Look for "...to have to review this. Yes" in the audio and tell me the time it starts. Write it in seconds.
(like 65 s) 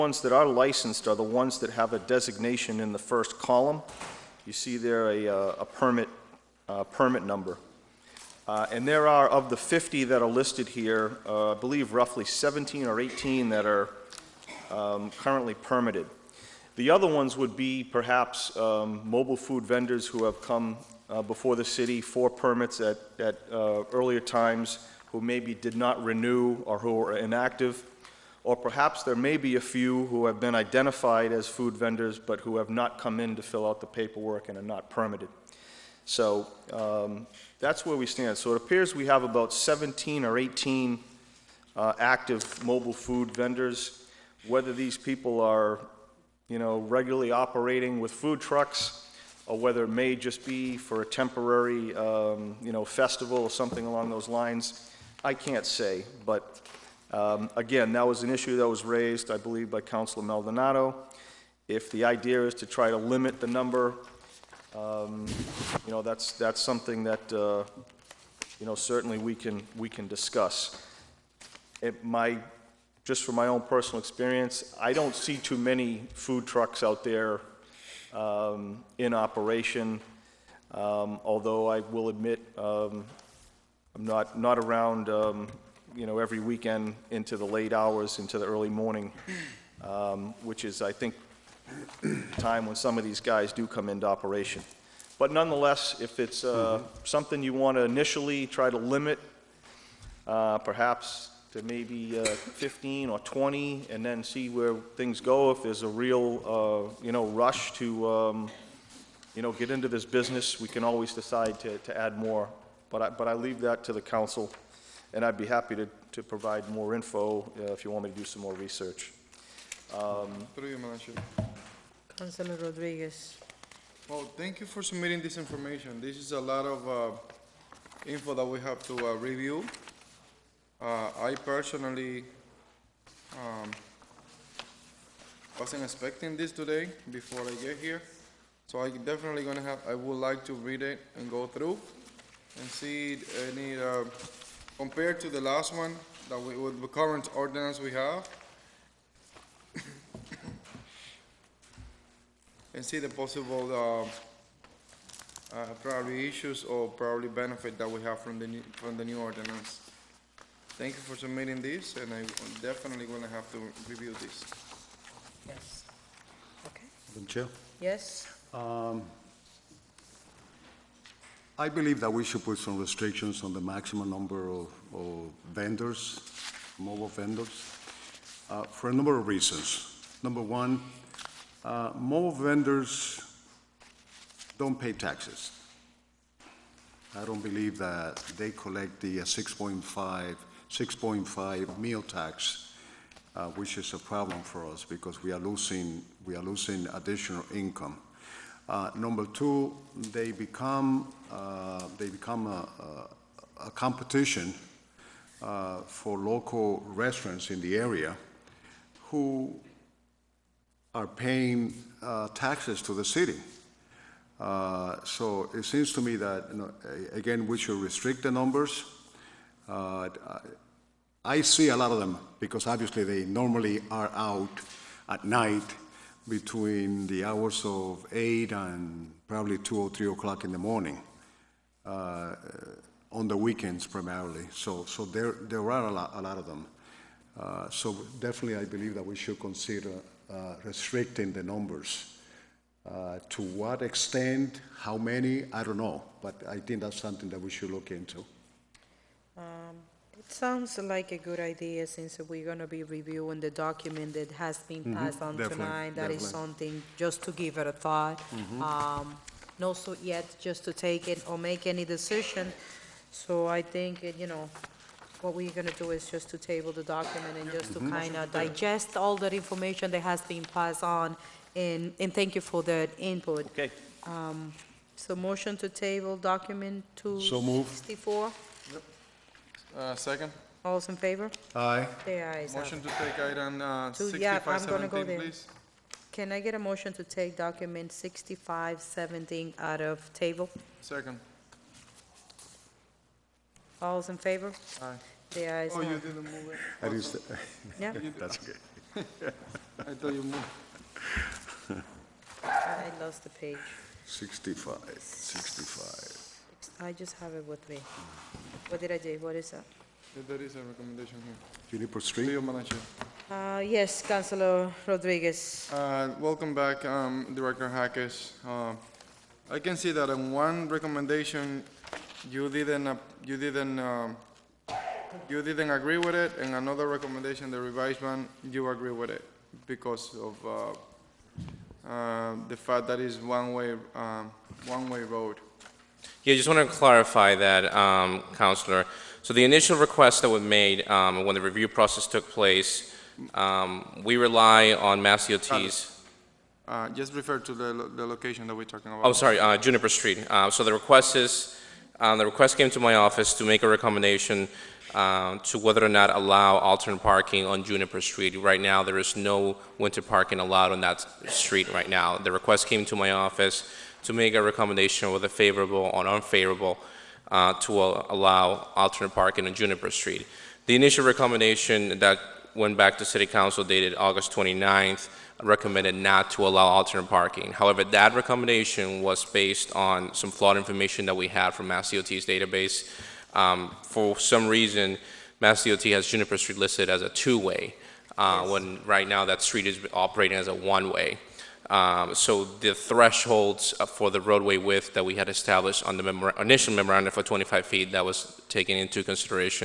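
163 s.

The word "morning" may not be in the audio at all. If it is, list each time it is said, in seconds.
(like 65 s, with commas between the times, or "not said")
88 s, 230 s.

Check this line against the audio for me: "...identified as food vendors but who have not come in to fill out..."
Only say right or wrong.
right.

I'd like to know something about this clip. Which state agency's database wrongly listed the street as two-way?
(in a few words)
MassDOT.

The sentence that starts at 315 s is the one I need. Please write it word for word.
Uh, Welcome back, um, Director Hackes.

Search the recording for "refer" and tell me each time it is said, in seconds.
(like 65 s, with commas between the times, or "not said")
347 s.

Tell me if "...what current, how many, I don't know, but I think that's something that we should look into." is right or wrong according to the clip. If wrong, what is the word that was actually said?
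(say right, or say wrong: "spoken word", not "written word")
wrong: "extent", not "current".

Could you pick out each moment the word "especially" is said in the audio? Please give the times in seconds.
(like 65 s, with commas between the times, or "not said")
not said.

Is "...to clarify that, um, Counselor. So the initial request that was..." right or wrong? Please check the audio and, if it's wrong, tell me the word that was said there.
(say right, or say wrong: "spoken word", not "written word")
right.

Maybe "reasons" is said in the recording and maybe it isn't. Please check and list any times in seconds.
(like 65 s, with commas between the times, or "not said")
179 s, 384 s.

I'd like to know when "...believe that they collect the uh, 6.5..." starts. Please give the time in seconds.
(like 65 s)
187 s.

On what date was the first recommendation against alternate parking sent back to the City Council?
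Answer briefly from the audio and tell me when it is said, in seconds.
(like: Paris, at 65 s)
August 29th, at 373 s.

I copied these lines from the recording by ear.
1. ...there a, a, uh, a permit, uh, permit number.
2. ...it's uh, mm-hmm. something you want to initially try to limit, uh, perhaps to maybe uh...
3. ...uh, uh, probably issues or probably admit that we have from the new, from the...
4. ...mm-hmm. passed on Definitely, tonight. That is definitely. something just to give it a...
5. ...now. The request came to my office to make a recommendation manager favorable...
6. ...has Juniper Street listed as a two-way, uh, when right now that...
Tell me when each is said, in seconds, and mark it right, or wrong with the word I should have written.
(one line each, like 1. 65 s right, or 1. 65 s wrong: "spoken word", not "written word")
1. 4 s right
2. 96 s right
3. 153 s wrong: "benefit", not "admit"
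4. 254 s right
5. 361 s wrong: "whether", not "manager"
6. 385 s right.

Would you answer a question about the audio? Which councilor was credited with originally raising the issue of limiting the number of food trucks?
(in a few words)
Maldonado.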